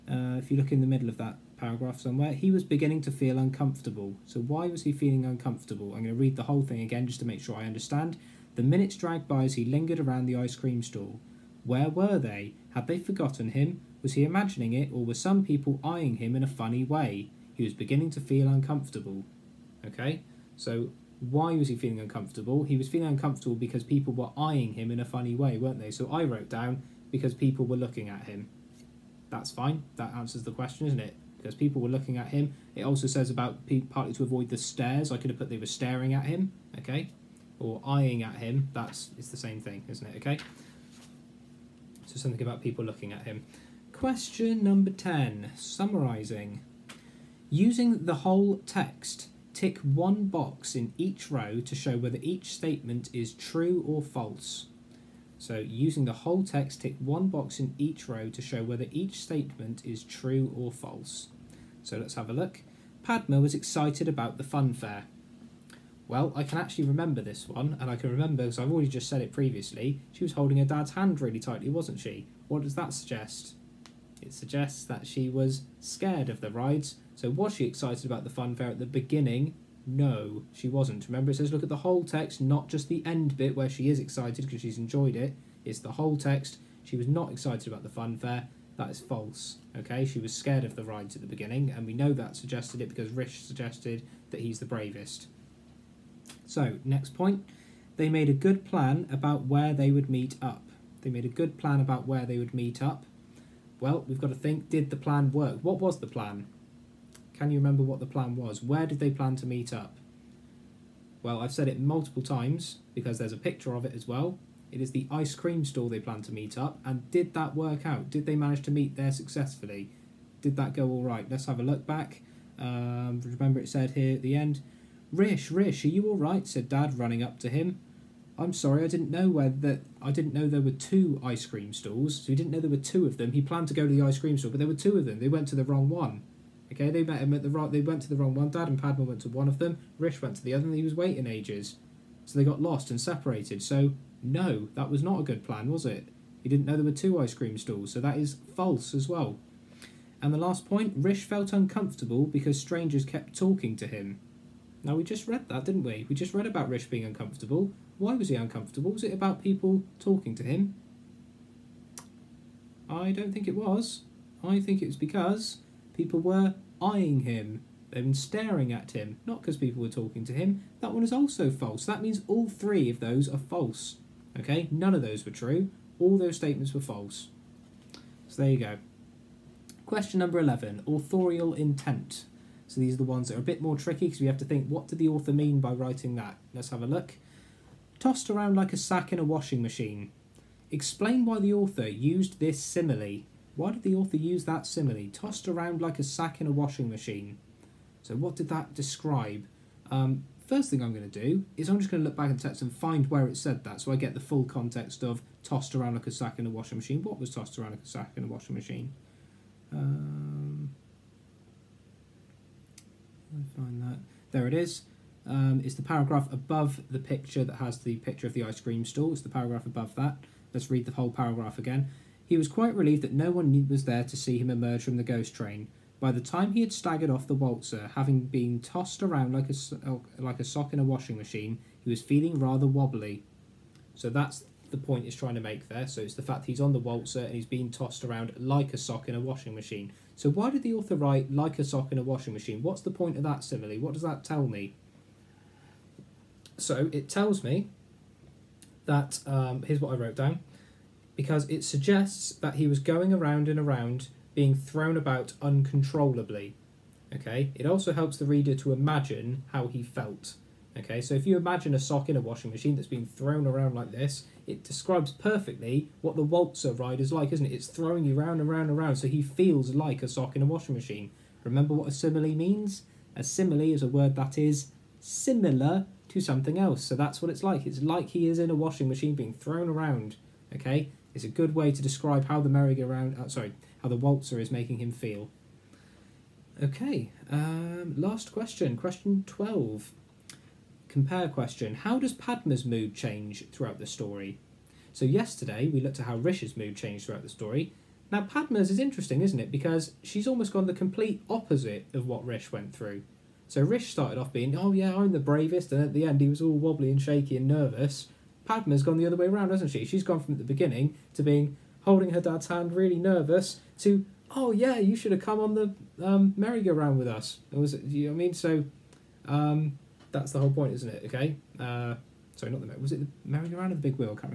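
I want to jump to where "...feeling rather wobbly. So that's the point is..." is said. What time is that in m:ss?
3:52.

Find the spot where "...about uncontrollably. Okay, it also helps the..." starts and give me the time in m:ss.
4:14.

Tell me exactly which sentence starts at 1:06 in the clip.
Well, I can actually remember this one, and I can remember because I've already just said it previously.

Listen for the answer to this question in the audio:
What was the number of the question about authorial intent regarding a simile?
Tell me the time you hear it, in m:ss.
2:59.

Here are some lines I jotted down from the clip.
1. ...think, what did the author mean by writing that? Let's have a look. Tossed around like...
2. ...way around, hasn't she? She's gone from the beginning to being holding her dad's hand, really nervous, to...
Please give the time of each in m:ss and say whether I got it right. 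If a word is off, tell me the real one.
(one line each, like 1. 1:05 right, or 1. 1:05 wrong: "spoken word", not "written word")
1. 3:04 right
2. 5:09 right.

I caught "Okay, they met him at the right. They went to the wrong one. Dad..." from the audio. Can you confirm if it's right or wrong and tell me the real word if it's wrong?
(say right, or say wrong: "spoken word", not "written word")
right.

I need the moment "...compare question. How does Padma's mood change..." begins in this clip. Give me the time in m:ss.
4:50.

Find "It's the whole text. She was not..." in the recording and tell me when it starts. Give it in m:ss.
1:25.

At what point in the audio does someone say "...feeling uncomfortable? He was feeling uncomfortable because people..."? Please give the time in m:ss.
0:21.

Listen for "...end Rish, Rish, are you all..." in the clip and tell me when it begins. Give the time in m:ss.
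2:04.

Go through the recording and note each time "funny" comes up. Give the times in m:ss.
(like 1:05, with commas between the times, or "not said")
0:16, 0:25.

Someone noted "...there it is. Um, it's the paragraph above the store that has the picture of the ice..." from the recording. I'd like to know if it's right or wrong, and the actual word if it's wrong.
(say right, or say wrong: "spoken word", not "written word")
wrong: "picture", not "store".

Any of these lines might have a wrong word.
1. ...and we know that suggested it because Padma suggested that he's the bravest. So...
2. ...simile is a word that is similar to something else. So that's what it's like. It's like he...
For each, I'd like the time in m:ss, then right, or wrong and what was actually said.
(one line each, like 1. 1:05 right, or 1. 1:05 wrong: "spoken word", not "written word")
1. 1:31 wrong: "Rish", not "Padma"
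2. 4:33 right.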